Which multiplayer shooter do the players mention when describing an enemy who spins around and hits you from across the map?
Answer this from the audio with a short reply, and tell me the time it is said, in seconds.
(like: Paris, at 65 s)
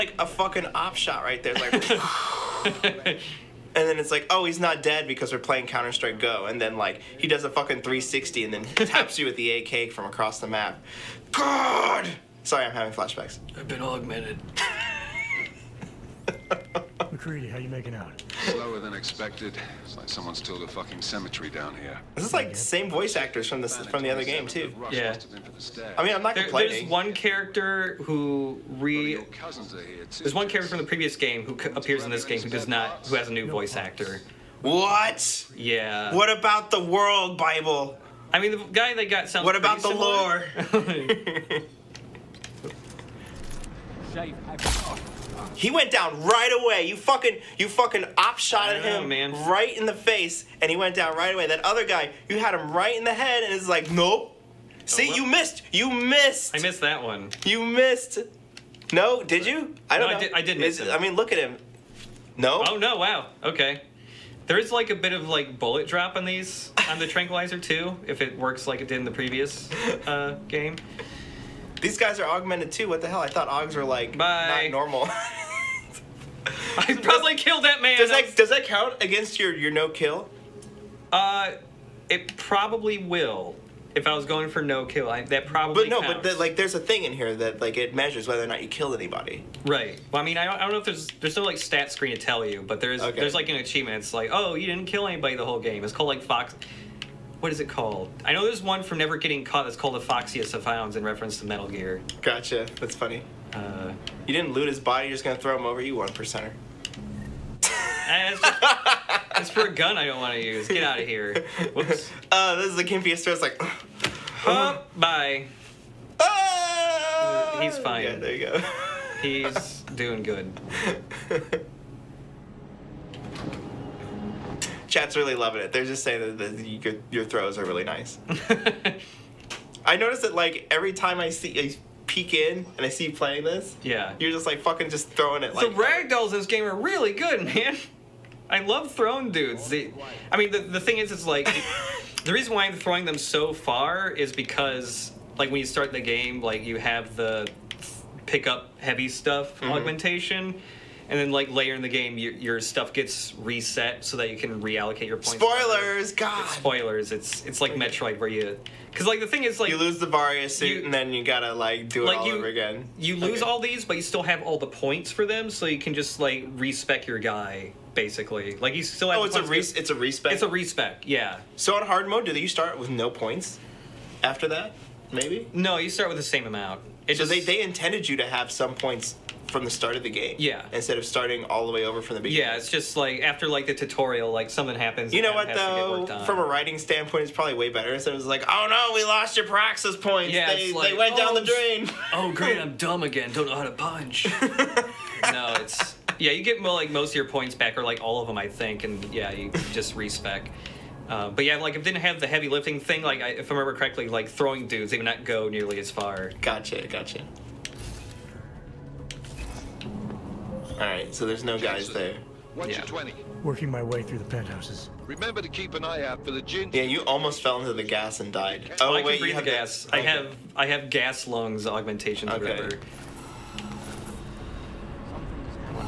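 Counter Strike Go, at 5 s.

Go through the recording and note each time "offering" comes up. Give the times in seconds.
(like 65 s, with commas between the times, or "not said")
not said.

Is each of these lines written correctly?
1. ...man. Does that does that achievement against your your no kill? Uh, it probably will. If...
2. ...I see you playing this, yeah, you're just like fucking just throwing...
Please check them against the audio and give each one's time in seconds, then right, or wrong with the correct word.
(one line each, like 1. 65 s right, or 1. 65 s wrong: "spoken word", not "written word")
1. 77 s wrong: "count", not "achievement"
2. 132 s right.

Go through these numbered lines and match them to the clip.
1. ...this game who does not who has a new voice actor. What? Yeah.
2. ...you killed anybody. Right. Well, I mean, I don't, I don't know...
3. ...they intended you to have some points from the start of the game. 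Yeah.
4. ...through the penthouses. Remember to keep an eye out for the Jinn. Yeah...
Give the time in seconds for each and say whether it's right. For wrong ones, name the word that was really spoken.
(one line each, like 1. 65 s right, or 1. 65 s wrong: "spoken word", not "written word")
1. 32 s right
2. 88 s right
3. 177 s right
4. 214 s right.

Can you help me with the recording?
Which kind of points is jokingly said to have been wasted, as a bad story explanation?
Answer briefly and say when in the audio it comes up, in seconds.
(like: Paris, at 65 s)
praxis points, at 189 s.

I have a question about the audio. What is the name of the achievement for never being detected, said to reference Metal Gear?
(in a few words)
Foxiest of Hounds.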